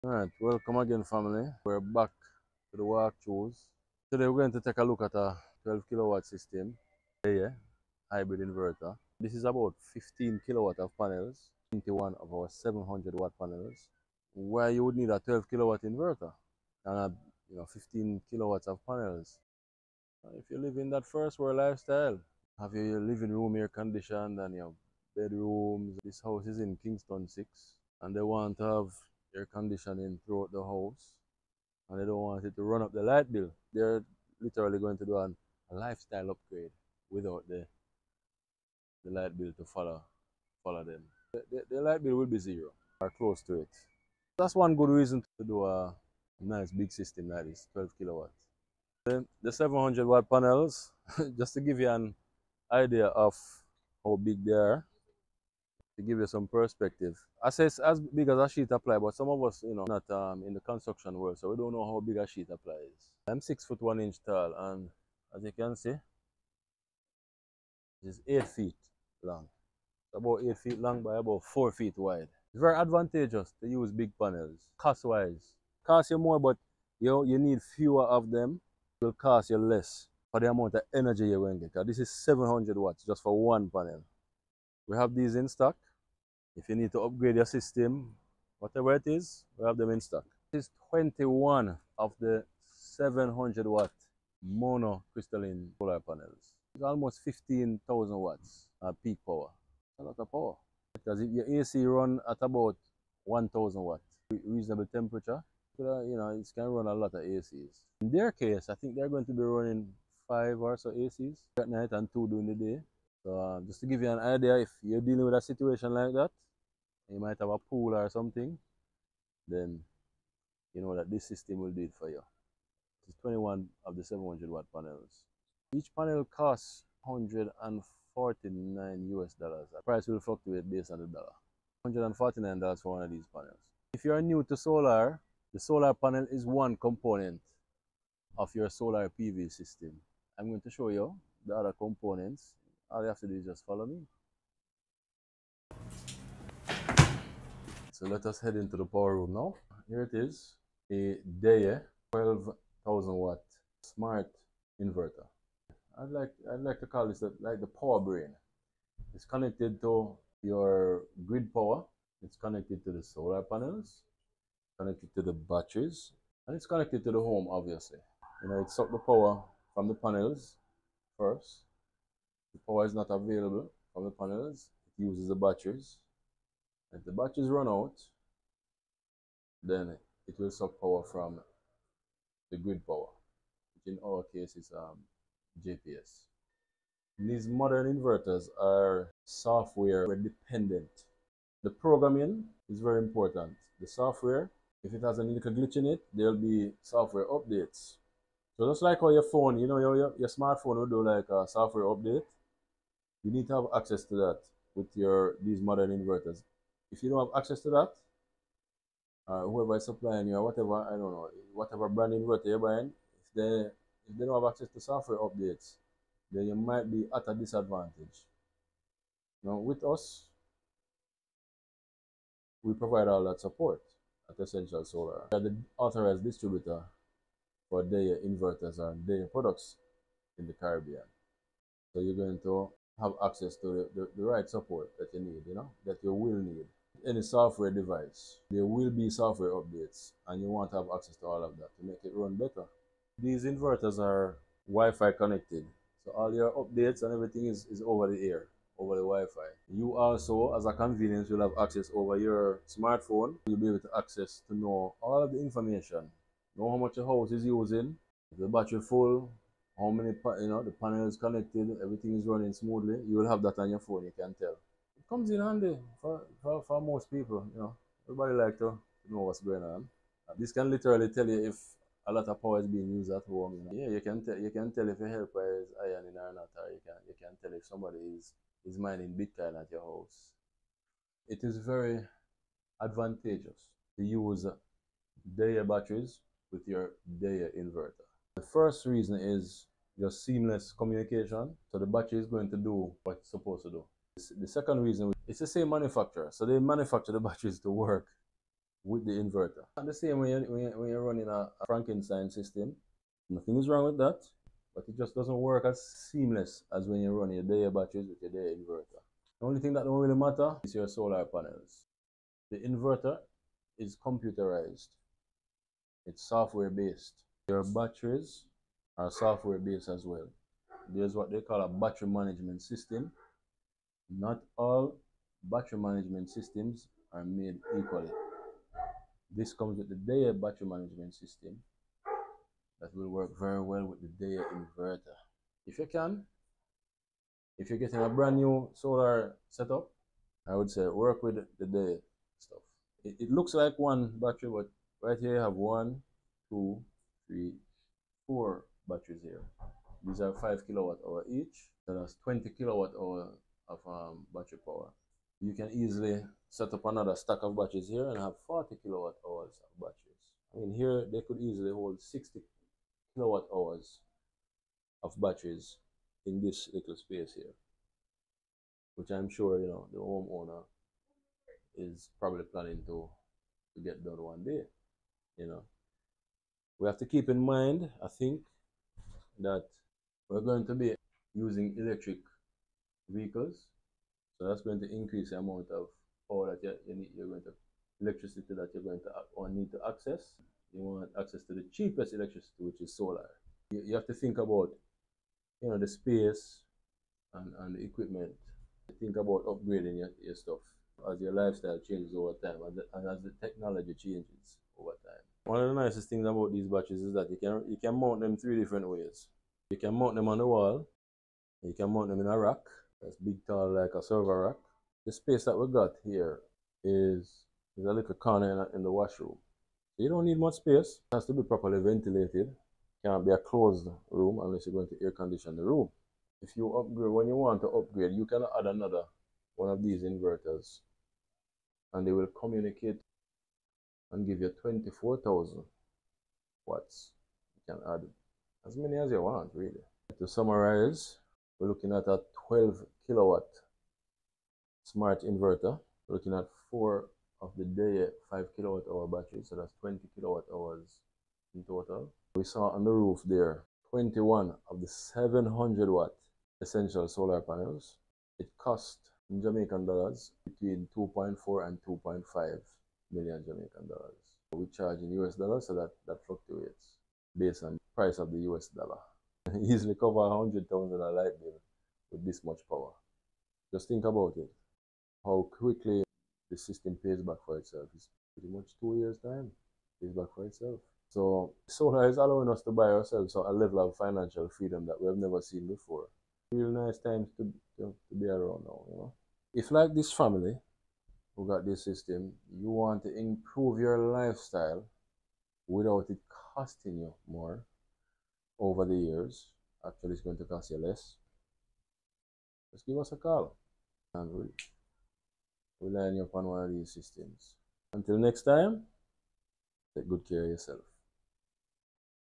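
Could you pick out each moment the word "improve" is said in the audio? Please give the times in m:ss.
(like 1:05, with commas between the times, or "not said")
8:13.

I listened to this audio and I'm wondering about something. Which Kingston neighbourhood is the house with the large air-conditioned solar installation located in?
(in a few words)
Kingston 6.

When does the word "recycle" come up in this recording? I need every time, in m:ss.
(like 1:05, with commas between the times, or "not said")
not said.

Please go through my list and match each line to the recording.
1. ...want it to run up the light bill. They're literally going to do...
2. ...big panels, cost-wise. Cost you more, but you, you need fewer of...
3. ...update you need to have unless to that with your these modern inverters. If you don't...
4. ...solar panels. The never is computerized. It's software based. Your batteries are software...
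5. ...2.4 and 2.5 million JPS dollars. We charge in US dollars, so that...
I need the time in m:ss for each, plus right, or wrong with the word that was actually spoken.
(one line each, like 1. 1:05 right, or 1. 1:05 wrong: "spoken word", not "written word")
1. 0:32 right
2. 1:13 right
3. 3:21 wrong: "access", not "unless"
4. 5:10 wrong: "inverter", not "never"
5. 7:40 wrong: "Jamaican", not "JPS".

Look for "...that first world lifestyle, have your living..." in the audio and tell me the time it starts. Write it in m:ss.
0:20.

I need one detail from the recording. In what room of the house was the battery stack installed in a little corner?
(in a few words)
Washroom.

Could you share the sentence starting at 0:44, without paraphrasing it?
That's one good reason to do a nice big system that is 12 kilowatts.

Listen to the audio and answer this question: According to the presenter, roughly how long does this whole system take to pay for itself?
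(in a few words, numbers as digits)
2 years.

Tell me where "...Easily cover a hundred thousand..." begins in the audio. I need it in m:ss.
7:49.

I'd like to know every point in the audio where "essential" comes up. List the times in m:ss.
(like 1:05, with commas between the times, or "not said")
3:44, 7:36.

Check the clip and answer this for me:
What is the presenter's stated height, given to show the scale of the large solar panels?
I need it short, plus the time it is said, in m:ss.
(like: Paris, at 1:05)
6 foot 1 inch, at 1:03.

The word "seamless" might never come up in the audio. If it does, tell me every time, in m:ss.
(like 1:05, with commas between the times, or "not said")
4:50, 5:06.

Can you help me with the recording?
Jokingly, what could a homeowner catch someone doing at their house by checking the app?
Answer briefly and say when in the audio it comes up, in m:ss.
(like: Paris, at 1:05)
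Mining Bitcoin, at 4:38.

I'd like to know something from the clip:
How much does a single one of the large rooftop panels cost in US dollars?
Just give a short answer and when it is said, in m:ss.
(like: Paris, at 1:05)
$149, at 2:07.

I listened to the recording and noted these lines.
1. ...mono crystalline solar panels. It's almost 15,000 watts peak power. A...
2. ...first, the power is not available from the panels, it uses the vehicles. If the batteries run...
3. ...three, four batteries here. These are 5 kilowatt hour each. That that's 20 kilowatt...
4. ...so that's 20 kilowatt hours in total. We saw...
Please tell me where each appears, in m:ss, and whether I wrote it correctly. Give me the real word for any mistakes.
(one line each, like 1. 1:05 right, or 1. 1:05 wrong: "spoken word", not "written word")
1. 1:34 right
2. 2:51 wrong: "batteries", not "vehicles"
3. 5:47 right
4. 7:29 right.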